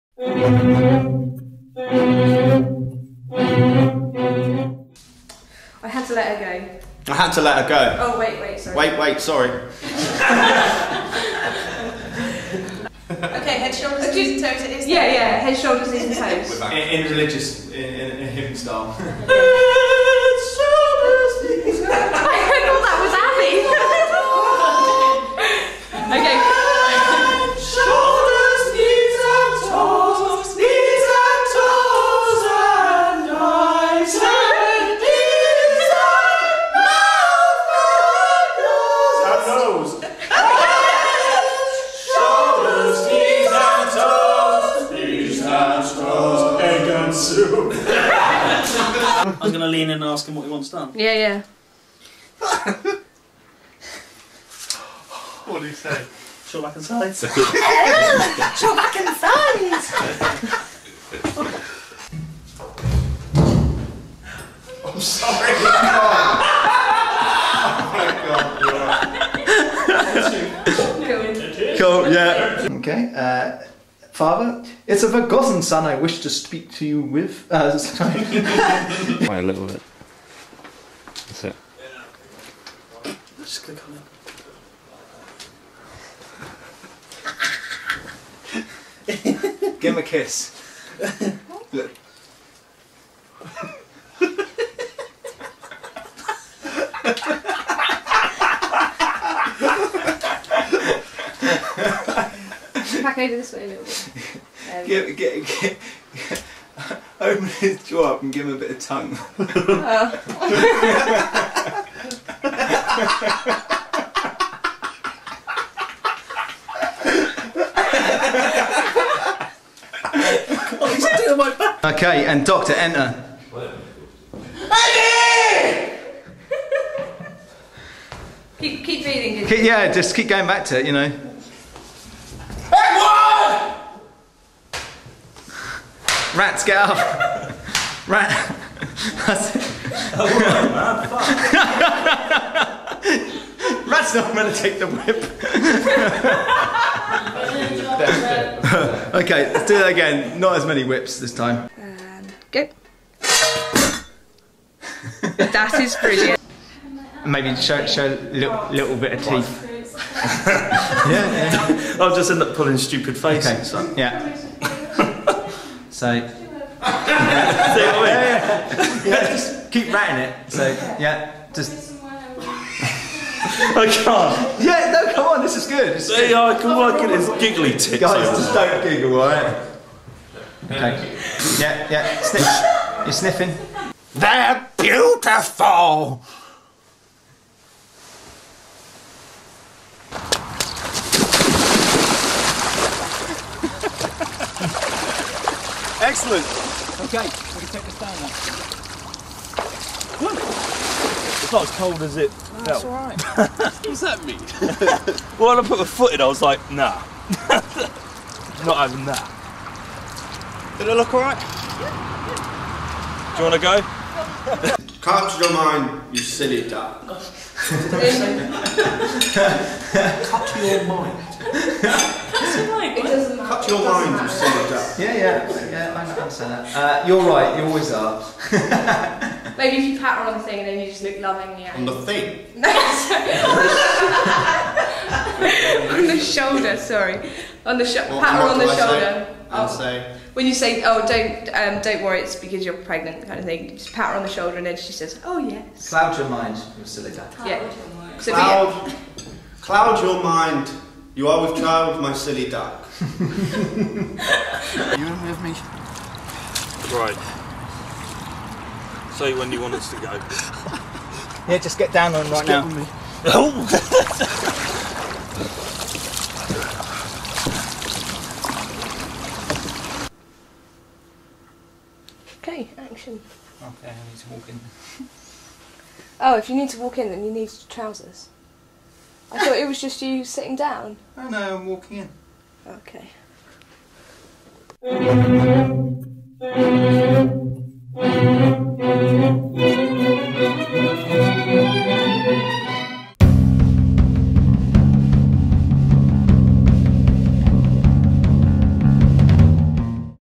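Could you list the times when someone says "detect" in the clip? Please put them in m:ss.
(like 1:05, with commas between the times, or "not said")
not said.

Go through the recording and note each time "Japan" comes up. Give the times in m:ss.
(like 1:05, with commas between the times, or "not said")
not said.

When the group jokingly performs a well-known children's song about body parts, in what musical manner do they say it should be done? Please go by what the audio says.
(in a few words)
hymn style.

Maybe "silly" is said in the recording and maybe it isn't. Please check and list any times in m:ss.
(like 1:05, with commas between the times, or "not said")
3:36, 3:44, 4:06, 4:12.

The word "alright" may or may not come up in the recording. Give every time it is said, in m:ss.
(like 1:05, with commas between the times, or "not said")
2:59, 3:22, 3:31.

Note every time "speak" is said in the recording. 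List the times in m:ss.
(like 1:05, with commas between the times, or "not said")
1:16.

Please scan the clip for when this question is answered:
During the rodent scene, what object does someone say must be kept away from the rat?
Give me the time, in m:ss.
2:24.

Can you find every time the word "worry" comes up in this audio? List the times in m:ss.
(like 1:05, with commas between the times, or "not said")
4:02.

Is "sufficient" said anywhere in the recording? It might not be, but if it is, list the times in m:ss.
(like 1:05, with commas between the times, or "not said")
not said.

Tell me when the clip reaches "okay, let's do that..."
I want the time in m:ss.
2:29.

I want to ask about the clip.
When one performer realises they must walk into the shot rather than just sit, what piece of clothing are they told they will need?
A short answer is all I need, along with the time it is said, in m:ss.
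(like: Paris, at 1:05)
trousers, at 4:37.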